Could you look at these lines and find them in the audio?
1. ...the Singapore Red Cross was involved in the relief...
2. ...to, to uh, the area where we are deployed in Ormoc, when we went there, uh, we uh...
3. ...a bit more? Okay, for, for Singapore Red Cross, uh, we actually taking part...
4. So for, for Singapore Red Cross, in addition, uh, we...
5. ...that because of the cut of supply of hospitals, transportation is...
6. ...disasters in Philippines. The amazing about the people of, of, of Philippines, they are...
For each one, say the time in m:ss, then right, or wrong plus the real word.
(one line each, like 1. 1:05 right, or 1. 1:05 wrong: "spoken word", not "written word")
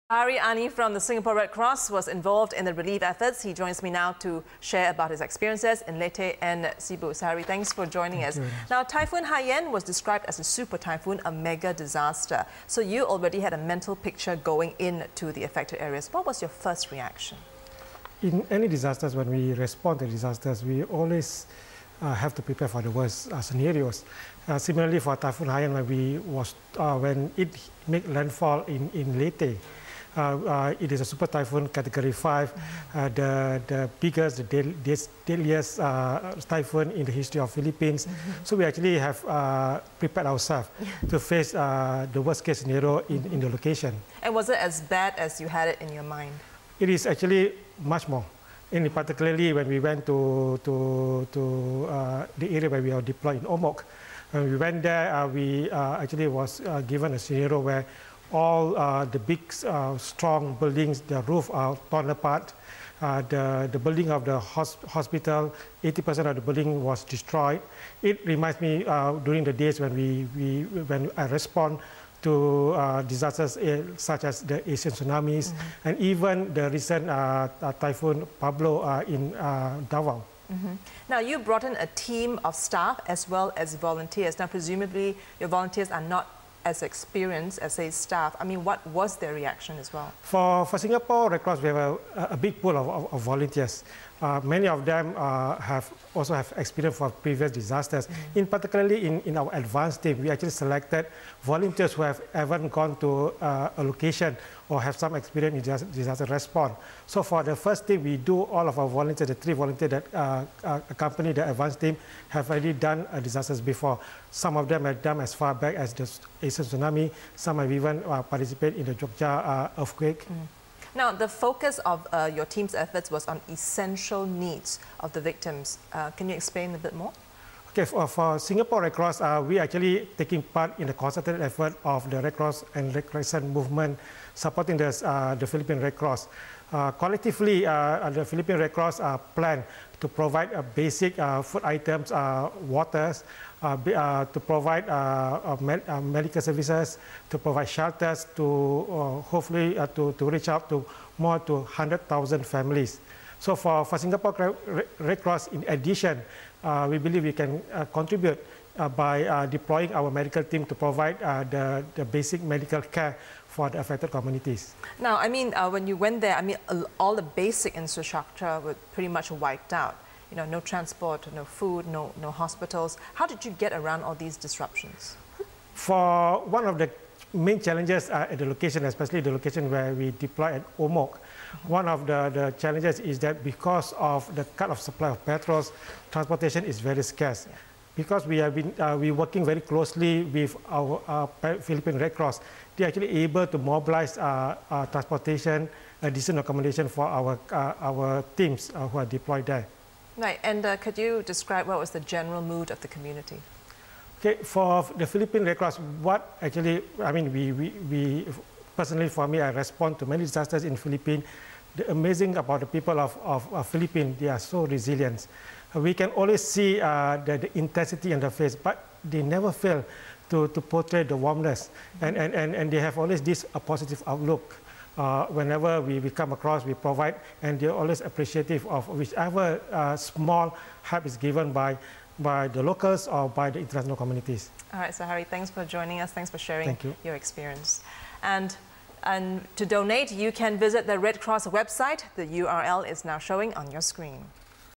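1. 0:00 right
2. 0:50 right
3. 2:06 right
4. 2:33 right
5. 3:03 wrong: "petrols", not "hospitals"
6. 3:30 right.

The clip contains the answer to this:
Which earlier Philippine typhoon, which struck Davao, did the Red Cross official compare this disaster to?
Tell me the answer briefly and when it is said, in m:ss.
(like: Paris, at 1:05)
Typhoon Pablo, at 1:17.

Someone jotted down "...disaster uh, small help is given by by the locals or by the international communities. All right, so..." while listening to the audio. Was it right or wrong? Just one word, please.
wrong.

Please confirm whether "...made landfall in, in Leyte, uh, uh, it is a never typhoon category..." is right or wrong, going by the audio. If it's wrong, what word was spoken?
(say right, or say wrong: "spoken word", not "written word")
wrong: "super", not "never".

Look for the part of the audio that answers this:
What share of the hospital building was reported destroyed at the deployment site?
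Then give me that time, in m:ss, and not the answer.
1:05.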